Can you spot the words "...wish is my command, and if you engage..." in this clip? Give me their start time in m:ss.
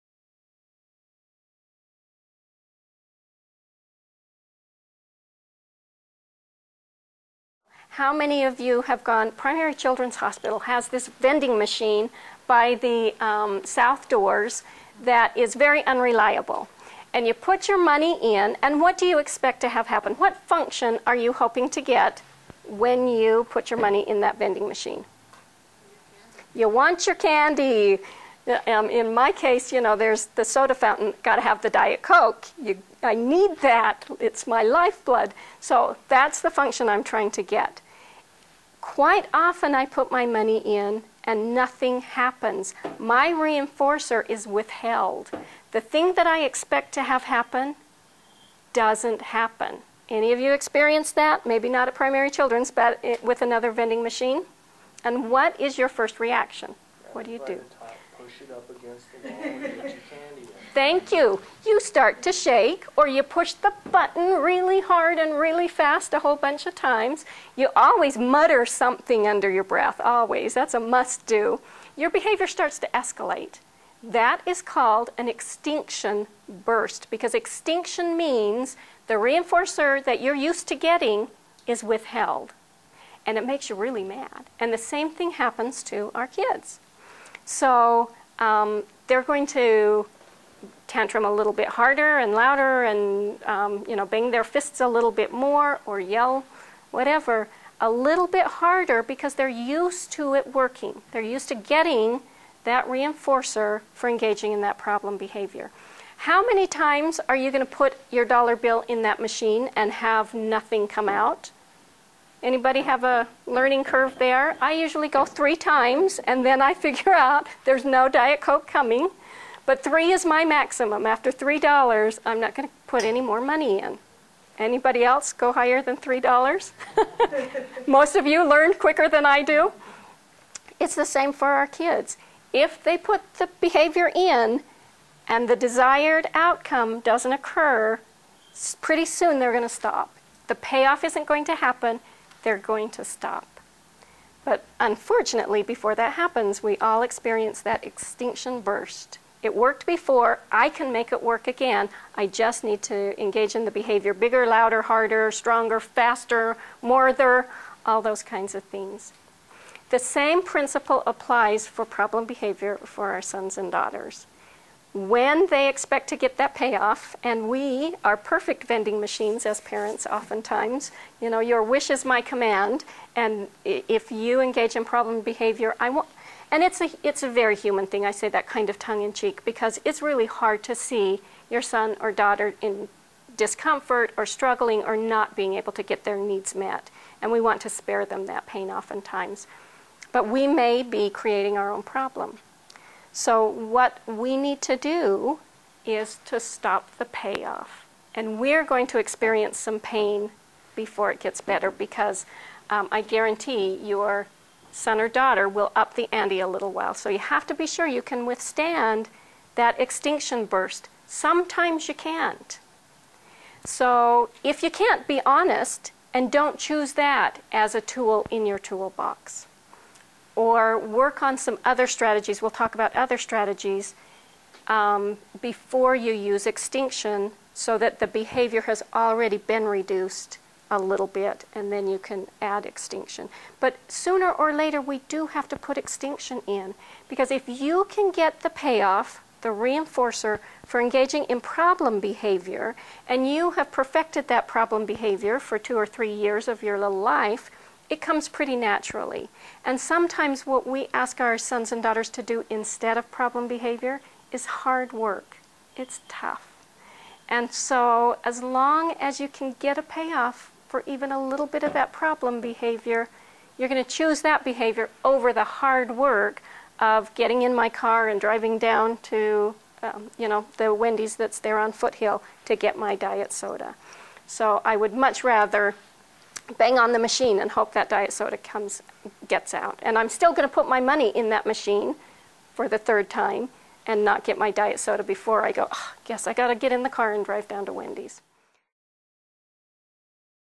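2:51.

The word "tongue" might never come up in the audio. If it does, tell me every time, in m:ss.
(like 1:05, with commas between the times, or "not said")
2:58.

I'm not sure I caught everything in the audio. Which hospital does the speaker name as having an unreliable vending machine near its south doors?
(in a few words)
Primary Children's Hospital.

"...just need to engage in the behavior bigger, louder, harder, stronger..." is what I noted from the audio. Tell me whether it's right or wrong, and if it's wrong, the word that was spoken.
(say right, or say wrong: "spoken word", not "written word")
right.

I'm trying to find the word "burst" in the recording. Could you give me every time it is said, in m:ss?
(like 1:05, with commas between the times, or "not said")
1:16, 2:28, 3:30.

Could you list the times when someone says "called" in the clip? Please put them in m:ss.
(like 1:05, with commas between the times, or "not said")
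1:14.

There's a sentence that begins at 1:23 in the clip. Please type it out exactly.
And it makes you really mad.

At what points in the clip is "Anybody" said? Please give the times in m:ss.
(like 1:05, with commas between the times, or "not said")
1:52, 2:04.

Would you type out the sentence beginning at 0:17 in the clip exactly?
And you put your money in, and what do you expect to have happen?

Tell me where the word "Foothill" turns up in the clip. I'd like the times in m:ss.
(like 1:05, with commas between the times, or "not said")
4:31.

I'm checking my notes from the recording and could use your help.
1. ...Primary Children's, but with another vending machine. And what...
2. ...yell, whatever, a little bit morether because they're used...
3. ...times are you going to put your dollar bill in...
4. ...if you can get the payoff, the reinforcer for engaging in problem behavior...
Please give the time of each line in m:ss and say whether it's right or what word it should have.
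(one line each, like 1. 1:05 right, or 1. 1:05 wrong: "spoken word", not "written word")
1. 0:51 right
2. 1:35 wrong: "harder", not "morether"
3. 1:46 right
4. 3:57 right.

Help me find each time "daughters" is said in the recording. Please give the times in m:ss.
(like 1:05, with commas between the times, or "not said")
2:43, 3:02, 3:25, 4:11.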